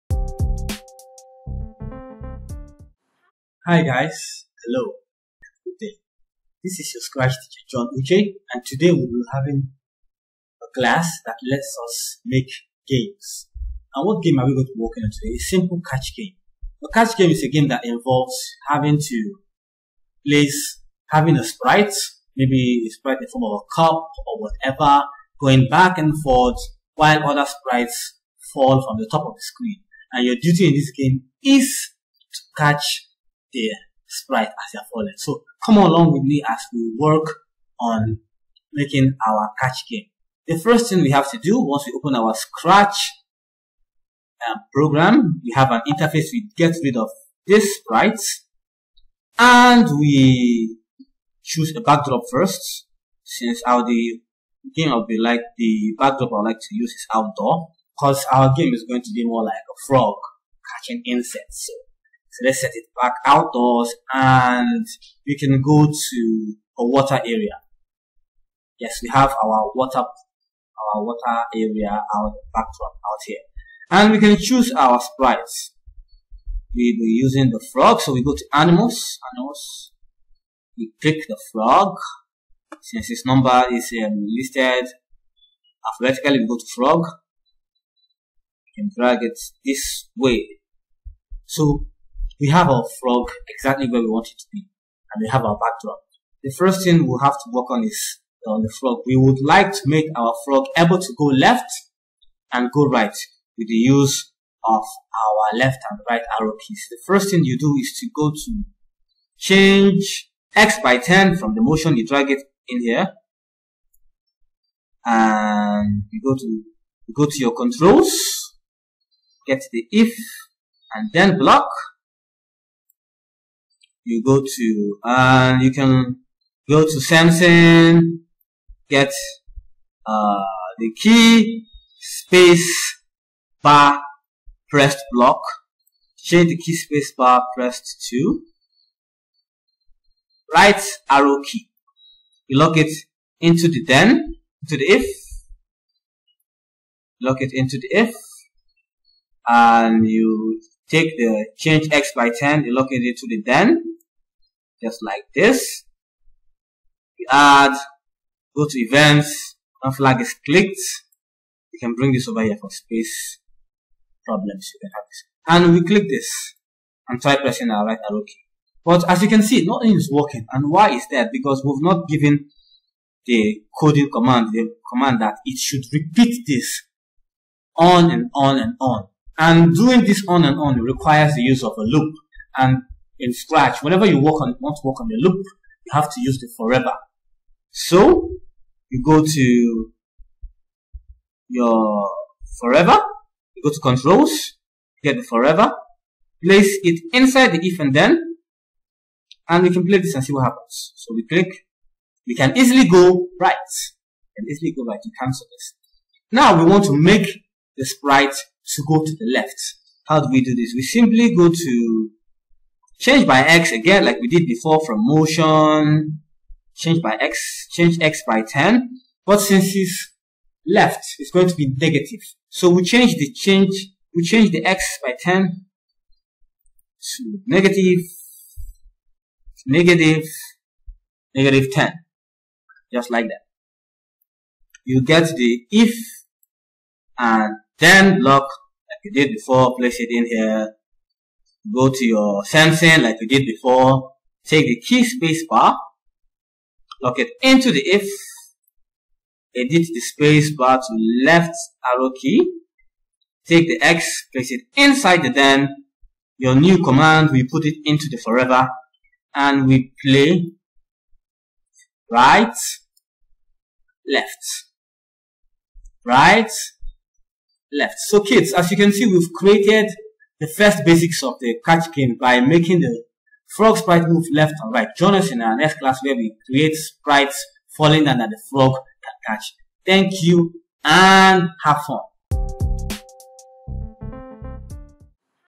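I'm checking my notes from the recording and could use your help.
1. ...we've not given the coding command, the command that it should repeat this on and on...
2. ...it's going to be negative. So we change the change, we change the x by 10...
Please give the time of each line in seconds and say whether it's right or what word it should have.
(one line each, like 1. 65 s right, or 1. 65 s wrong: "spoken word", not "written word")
1. 171 s right
2. 221 s right.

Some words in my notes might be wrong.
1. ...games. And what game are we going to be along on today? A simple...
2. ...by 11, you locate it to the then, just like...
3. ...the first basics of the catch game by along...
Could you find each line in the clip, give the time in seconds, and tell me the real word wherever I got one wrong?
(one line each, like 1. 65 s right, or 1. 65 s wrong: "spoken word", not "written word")
1. 12 s wrong: "working", not "along"
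2. 152 s wrong: "10", not "11"
3. 270 s wrong: "making", not "along".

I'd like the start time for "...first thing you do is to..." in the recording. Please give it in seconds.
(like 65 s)
107 s.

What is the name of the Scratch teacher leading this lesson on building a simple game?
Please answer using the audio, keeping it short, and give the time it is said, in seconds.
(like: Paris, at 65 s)
John Uche, at 7 s.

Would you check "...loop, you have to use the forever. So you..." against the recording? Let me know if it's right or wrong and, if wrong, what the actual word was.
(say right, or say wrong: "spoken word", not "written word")
right.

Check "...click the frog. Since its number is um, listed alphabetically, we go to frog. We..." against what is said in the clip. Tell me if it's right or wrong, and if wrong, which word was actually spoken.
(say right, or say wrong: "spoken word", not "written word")
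right.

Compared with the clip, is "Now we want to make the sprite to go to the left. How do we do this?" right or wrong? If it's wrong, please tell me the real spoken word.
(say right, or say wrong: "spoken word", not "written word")
right.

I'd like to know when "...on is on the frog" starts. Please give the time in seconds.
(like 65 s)
97 s.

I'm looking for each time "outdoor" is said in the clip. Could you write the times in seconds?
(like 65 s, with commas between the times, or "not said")
57 s, 63 s.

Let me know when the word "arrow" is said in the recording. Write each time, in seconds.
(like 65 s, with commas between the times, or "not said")
106 s, 141 s, 168 s, 251 s.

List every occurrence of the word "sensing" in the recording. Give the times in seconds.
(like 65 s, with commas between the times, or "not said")
127 s, 242 s.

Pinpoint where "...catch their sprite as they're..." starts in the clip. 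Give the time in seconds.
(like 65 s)
32 s.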